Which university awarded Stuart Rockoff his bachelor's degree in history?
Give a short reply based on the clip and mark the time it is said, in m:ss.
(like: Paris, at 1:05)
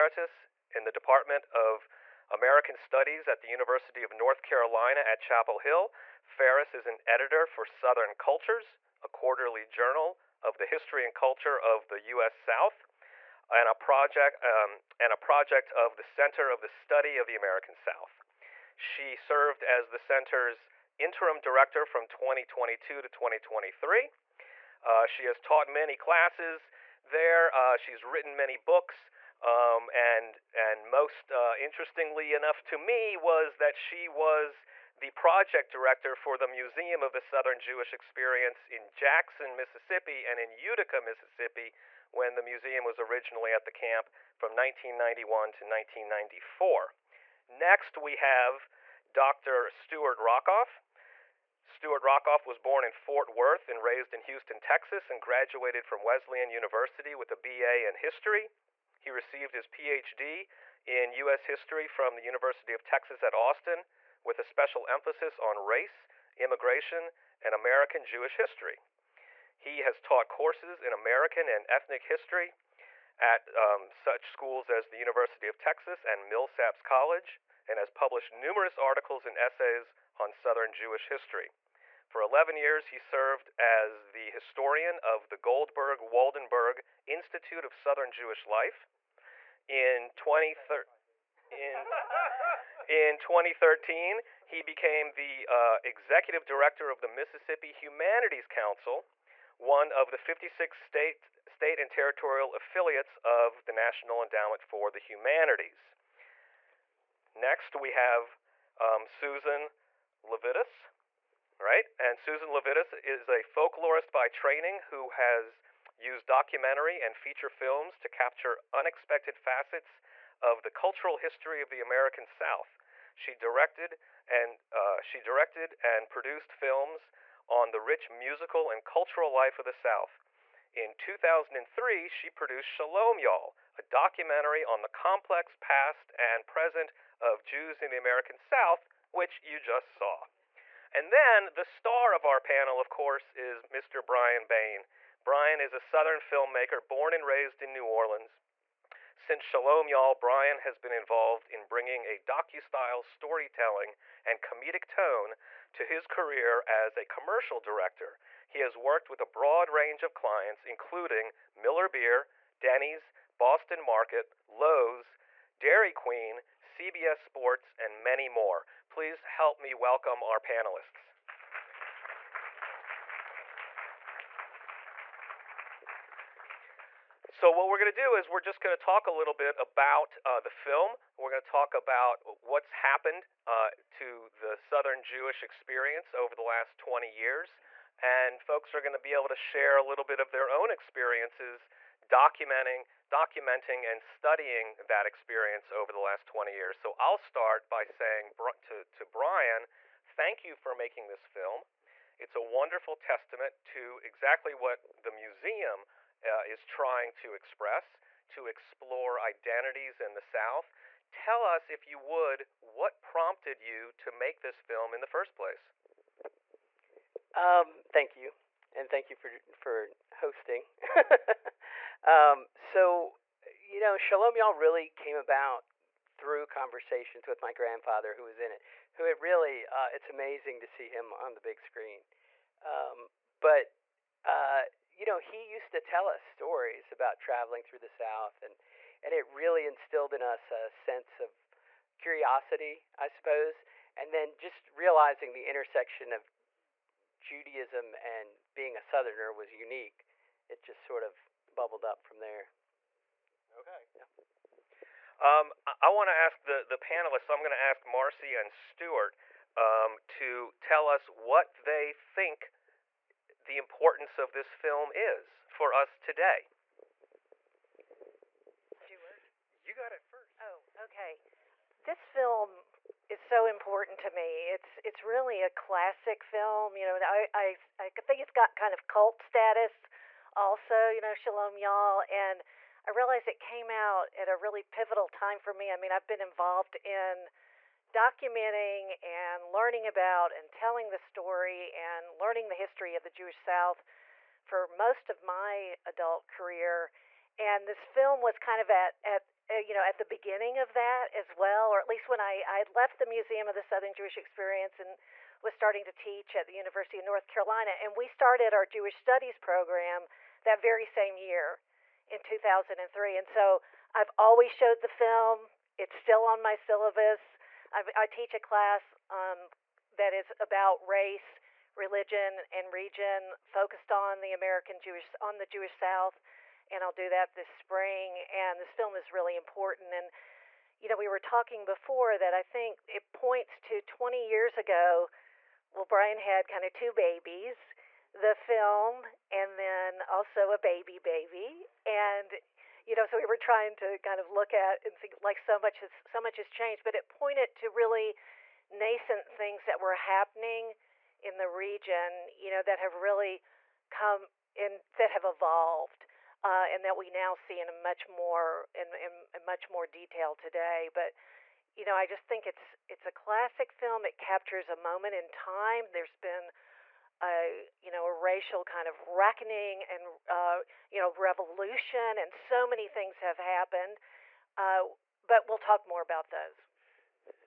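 Wesleyan University, at 0:56.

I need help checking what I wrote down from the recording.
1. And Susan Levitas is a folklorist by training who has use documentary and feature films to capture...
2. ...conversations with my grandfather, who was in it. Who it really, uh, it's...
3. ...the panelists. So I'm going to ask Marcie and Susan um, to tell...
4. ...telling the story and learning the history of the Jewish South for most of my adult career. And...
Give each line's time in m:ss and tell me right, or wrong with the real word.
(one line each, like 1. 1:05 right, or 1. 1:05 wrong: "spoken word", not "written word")
1. 1:51 right
2. 3:46 right
3. 4:16 wrong: "Stuart", not "Susan"
4. 4:50 right.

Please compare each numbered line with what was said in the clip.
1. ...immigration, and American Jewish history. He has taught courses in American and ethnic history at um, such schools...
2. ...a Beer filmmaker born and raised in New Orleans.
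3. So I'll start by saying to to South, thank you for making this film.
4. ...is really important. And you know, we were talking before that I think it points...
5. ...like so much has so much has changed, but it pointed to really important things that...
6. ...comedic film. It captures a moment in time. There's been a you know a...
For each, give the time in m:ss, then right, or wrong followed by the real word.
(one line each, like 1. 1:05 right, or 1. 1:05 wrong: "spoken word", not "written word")
1. 1:06 right
2. 2:25 wrong: "Southern", not "Beer"
3. 3:16 wrong: "Brian", not "South"
4. 5:28 right
5. 5:45 wrong: "nascent", not "important"
6. 6:03 wrong: "classic", not "comedic".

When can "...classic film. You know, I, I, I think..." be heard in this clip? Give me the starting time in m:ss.
4:35.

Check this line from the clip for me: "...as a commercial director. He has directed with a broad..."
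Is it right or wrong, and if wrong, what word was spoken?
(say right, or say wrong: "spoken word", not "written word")
wrong: "worked", not "directed".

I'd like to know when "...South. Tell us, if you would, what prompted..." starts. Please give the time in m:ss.
3:30.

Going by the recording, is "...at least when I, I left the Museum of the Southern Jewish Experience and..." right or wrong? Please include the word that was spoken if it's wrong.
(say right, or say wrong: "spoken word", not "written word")
right.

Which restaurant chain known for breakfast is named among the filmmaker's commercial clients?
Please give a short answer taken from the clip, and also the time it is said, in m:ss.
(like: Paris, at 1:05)
Denny's, at 2:42.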